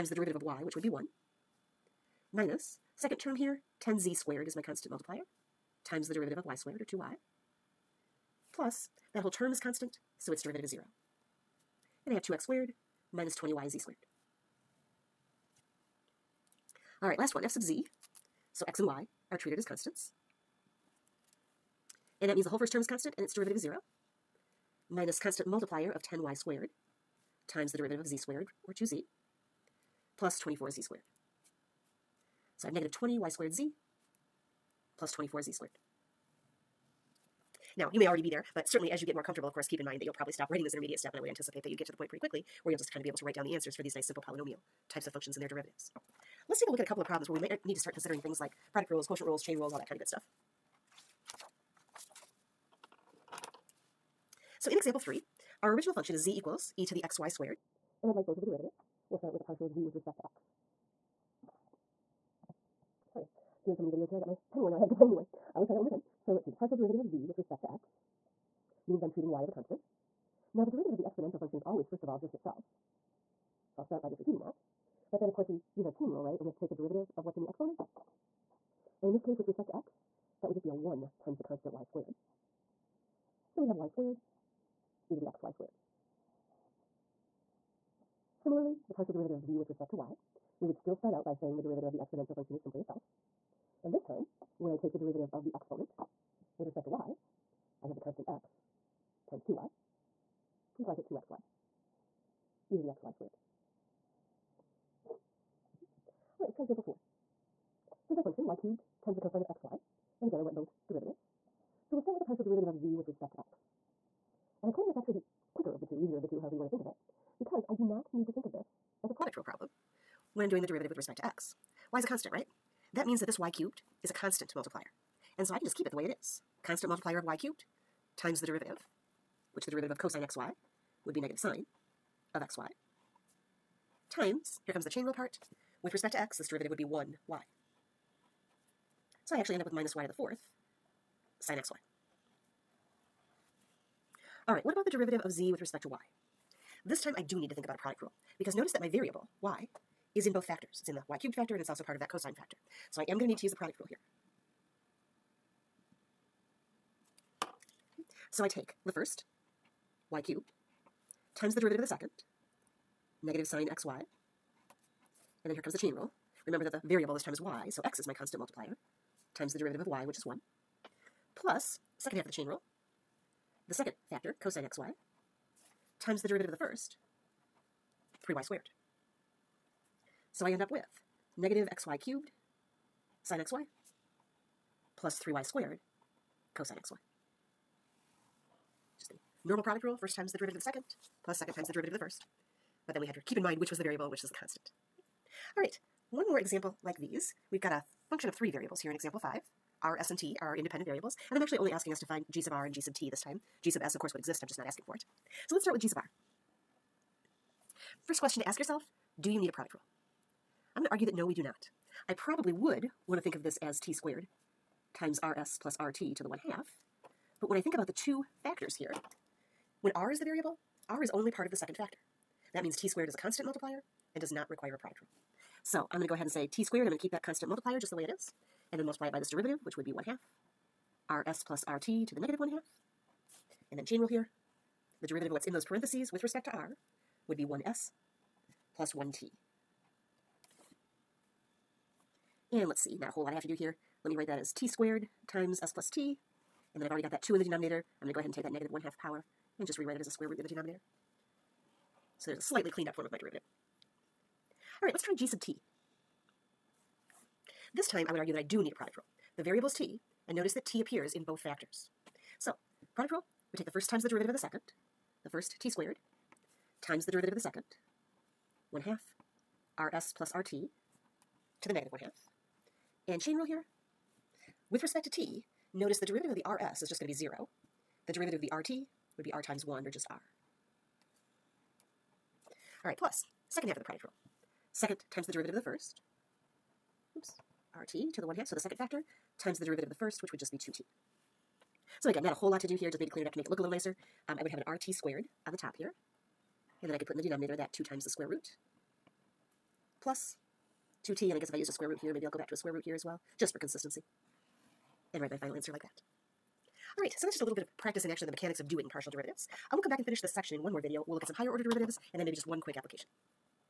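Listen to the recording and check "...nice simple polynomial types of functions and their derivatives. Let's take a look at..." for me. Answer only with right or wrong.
right.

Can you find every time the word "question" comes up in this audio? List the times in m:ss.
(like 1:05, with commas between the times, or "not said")
3:28.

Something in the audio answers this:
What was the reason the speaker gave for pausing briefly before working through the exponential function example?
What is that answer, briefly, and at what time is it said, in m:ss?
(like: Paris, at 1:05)
pen worn out, at 1:04.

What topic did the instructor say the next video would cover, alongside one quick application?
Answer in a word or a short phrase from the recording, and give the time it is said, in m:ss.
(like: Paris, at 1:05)
higher order derivatives, at 5:11.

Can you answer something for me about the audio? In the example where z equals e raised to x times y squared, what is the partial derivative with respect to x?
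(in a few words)
y squared e to the xy squared.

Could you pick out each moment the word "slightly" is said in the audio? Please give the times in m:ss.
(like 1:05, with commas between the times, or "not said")
4:12.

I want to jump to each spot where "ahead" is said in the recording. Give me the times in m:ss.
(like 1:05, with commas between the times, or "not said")
3:46, 4:08.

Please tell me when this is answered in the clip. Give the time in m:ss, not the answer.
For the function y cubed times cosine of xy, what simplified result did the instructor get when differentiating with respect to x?
2:19.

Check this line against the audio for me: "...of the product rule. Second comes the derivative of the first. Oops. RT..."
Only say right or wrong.
wrong.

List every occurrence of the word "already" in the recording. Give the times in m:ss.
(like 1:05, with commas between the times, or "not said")
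0:38, 4:06.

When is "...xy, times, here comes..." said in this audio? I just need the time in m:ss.
2:12.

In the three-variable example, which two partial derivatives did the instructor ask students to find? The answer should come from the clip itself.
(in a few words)
G sub R and G sub T.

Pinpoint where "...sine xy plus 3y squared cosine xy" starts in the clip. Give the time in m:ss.
3:03.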